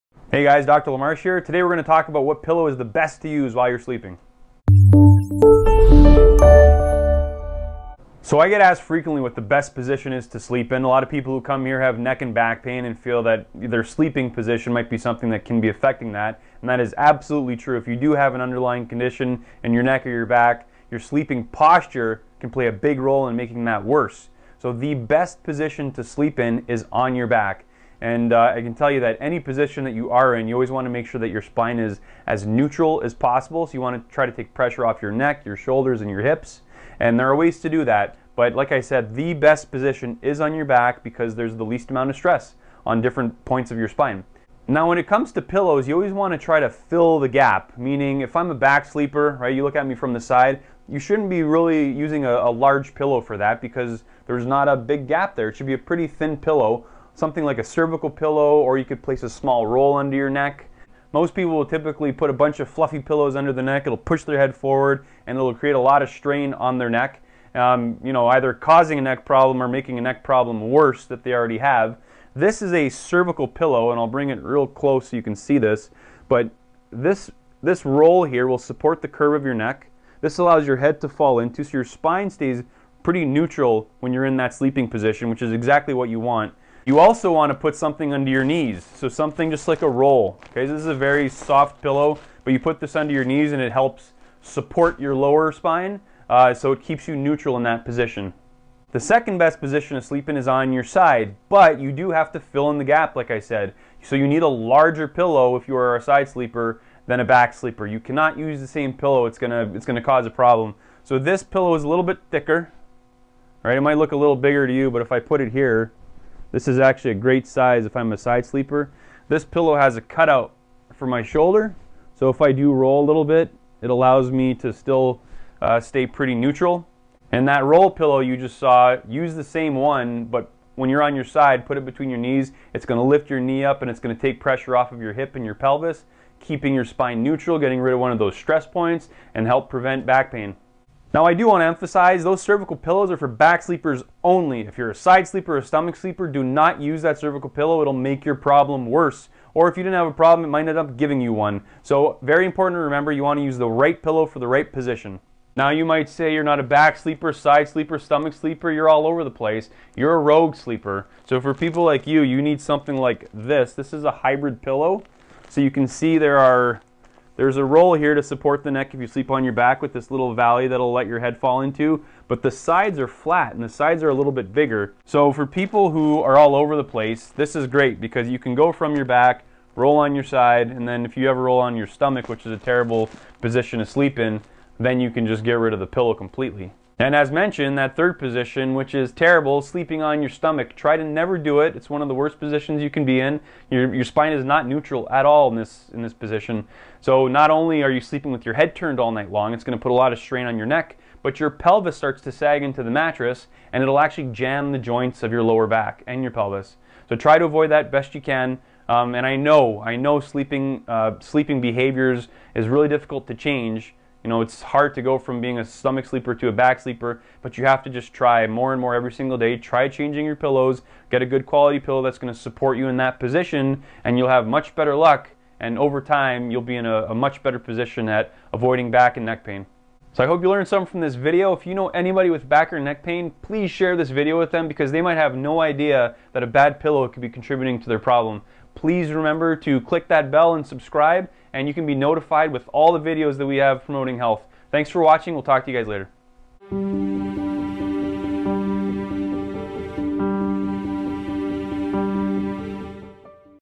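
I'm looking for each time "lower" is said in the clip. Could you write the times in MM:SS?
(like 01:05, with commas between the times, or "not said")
01:35, 03:25.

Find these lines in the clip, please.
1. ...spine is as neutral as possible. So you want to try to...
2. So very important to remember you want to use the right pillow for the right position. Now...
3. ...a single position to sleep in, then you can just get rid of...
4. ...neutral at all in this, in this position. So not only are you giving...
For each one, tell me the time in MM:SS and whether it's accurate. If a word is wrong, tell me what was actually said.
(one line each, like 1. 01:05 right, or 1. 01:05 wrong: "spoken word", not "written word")
1. 00:31 right
2. 02:31 right
3. 03:02 wrong: "terrible", not "single"
4. 03:14 wrong: "sleeping", not "giving".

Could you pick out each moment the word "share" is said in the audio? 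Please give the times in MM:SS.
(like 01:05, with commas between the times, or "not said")
03:53.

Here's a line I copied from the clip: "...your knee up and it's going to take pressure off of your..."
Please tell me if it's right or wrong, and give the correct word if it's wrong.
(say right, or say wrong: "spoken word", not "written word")
right.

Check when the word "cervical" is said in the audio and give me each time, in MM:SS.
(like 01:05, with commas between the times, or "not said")
00:57, 01:12, 02:22, 02:27.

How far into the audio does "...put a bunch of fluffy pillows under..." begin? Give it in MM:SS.
01:02.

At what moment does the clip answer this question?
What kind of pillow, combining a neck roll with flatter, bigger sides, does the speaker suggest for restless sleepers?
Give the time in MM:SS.
02:44.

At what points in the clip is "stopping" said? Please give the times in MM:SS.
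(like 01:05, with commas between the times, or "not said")
not said.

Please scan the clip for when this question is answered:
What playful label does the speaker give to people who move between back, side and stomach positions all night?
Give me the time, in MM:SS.
02:40.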